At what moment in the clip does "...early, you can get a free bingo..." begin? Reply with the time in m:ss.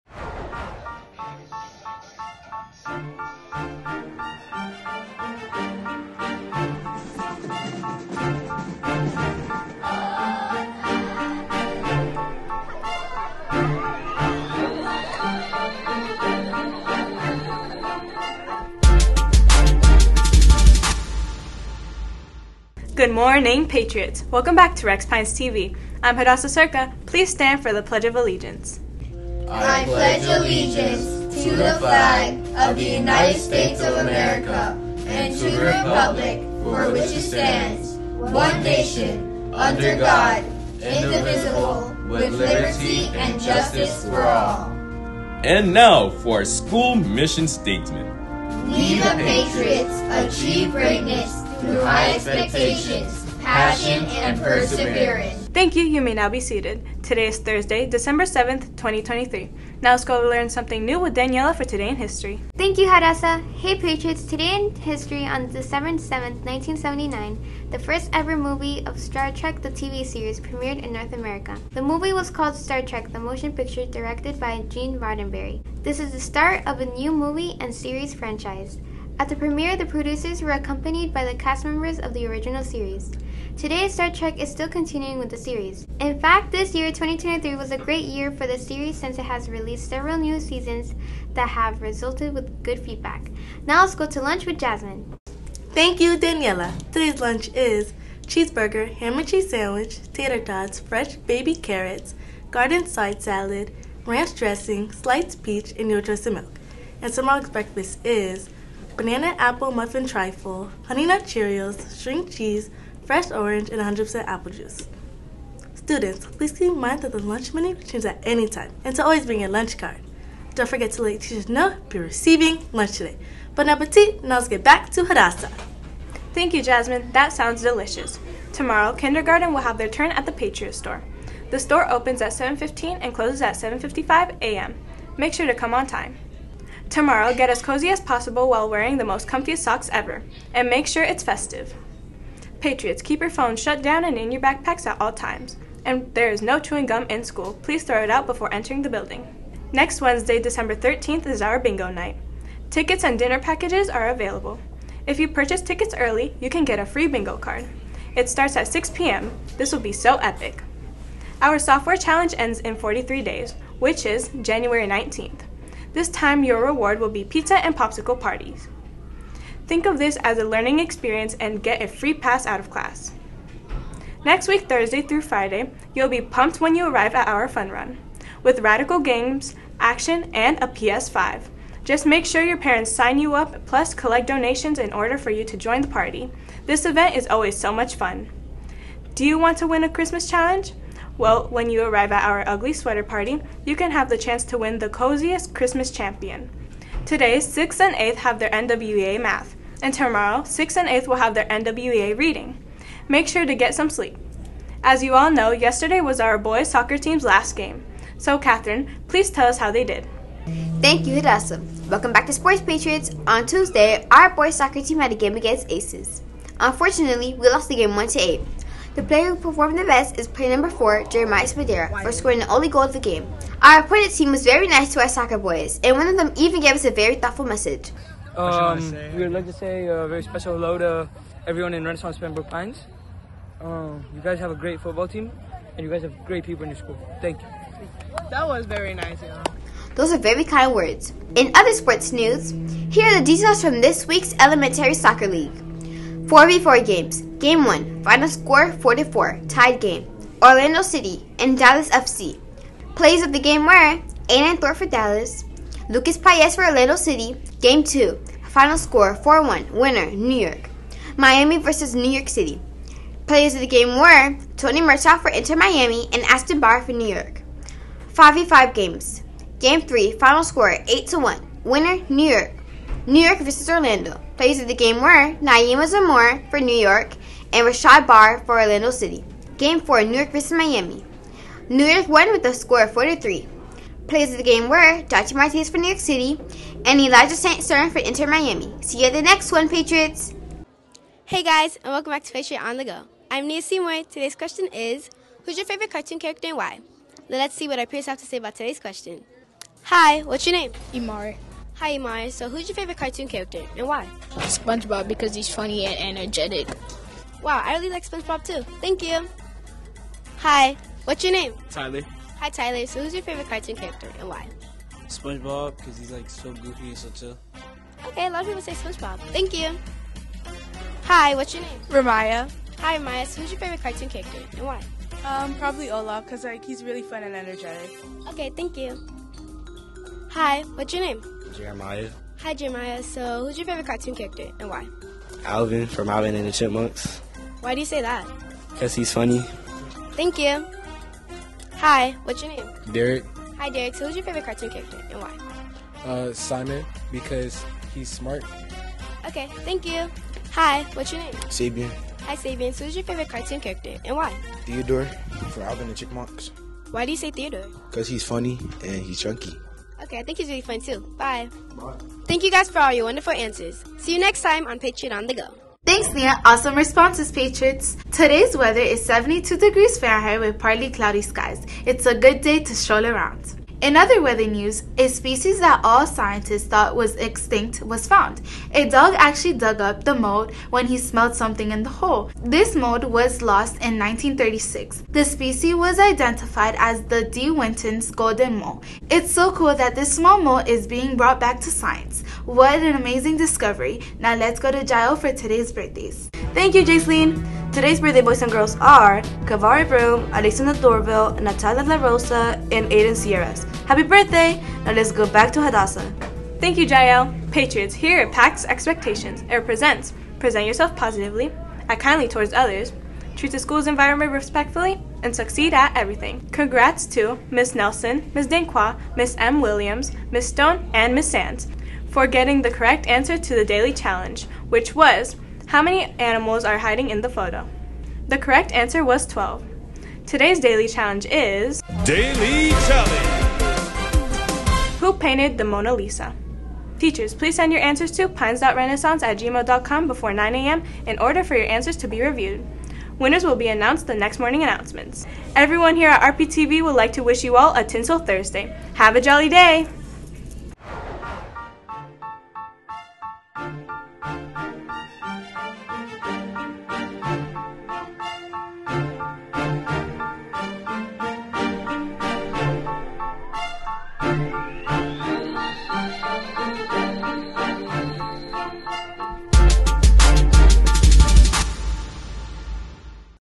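2:35.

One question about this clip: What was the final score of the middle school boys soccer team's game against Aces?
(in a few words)
1 to 8.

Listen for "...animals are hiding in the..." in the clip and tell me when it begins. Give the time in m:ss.
7:06.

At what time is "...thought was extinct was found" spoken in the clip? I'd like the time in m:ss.
6:16.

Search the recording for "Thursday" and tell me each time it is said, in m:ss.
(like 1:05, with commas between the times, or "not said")
0:57, 2:54, 7:28.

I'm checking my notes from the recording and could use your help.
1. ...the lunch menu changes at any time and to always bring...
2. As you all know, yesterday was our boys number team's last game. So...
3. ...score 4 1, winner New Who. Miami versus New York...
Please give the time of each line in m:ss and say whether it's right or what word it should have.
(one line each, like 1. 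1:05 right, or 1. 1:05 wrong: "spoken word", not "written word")
1. 1:57 right
2. 3:24 wrong: "soccer", not "number"
3. 4:18 wrong: "York", not "Who".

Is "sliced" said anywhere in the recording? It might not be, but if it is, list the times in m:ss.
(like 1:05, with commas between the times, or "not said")
1:44.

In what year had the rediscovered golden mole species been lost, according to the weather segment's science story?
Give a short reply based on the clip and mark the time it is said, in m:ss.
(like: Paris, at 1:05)
1936, at 6:23.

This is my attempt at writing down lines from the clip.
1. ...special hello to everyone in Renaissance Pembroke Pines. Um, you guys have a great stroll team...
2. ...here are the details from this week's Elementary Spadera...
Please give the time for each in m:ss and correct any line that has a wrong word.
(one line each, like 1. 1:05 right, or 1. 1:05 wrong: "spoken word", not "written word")
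1. 3:50 wrong: "football", not "stroll"
2. 4:02 wrong: "Soccer", not "Spadera".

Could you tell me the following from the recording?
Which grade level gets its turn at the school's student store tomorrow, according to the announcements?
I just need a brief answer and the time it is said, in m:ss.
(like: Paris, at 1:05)
kindergarten, at 2:08.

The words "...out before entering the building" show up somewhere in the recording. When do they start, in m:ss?
2:28.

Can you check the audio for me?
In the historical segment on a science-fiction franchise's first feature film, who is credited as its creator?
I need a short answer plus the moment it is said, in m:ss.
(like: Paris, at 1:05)
Gene Roddenberry, at 1:14.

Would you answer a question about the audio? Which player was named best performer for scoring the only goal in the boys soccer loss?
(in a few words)
Jeremiah Spadera.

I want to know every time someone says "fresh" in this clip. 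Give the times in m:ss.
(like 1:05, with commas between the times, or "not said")
1:40, 1:53.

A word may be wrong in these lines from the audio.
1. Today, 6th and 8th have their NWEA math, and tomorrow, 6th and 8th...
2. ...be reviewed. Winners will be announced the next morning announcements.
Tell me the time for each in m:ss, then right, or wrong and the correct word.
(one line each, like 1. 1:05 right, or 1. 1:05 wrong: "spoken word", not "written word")
1. 3:17 right
2. 7:22 right.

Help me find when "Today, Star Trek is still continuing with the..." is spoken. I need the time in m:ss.
1:23.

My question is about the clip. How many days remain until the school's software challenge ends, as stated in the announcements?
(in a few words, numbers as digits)
43.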